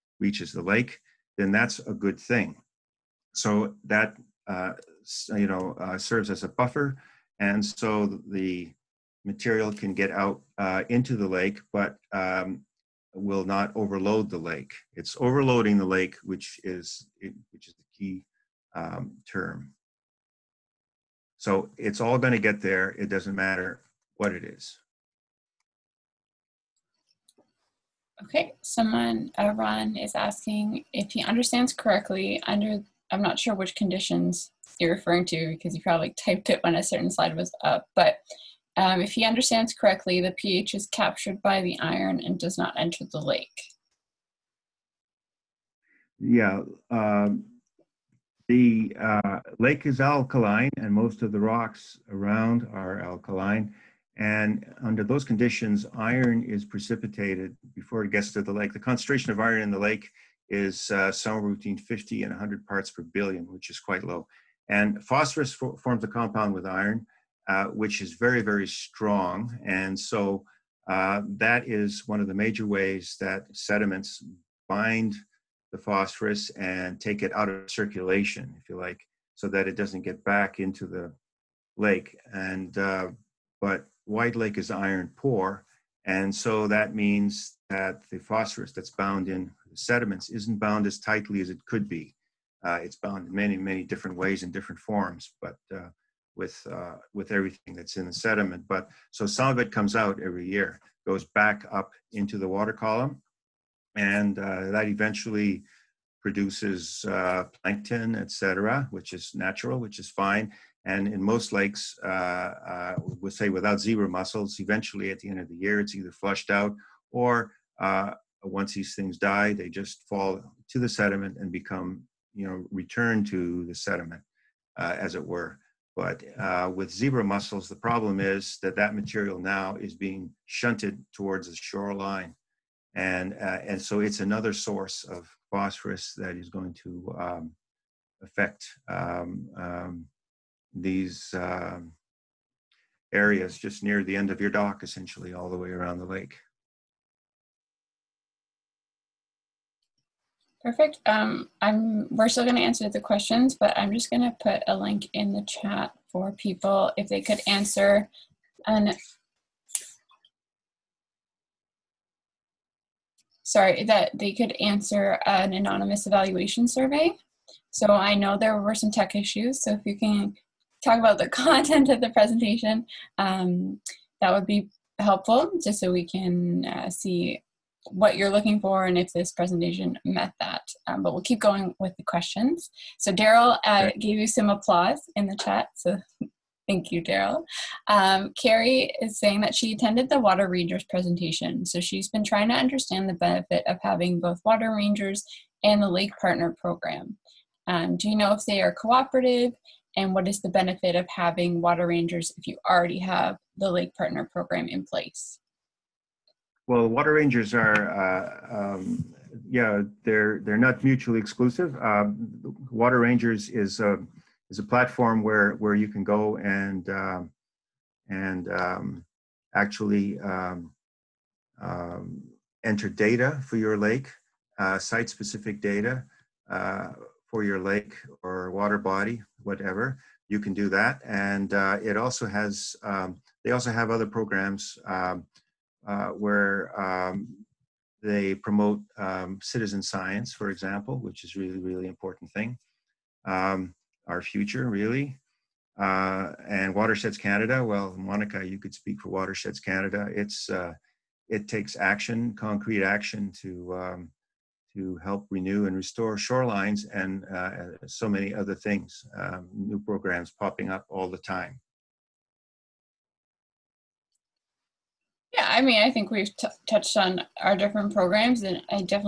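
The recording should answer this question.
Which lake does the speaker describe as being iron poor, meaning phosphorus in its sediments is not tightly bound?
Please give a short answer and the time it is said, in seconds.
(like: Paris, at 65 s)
White Lake, at 84 s.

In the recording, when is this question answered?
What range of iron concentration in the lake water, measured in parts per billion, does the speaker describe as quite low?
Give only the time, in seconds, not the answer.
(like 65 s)
61 s.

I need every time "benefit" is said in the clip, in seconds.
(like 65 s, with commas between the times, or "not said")
193 s, 200 s.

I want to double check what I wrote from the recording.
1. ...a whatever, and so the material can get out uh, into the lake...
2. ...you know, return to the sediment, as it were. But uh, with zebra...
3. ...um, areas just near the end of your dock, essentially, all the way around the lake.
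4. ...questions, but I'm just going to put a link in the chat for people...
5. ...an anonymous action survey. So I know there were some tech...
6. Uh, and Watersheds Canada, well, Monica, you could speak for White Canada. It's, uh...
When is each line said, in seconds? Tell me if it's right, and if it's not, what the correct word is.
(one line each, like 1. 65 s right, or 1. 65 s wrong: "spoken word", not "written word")
1. 6 s wrong: "buffer", not "whatever"
2. 122 s right
3. 141 s right
4. 152 s right
5. 165 s wrong: "evaluation", not "action"
6. 245 s wrong: "Watersheds", not "White".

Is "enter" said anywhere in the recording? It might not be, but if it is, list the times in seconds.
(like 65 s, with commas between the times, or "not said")
42 s, 222 s.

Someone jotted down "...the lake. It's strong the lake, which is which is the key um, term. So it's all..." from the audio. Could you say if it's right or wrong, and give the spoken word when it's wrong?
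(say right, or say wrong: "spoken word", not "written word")
wrong: "overloading", not "strong".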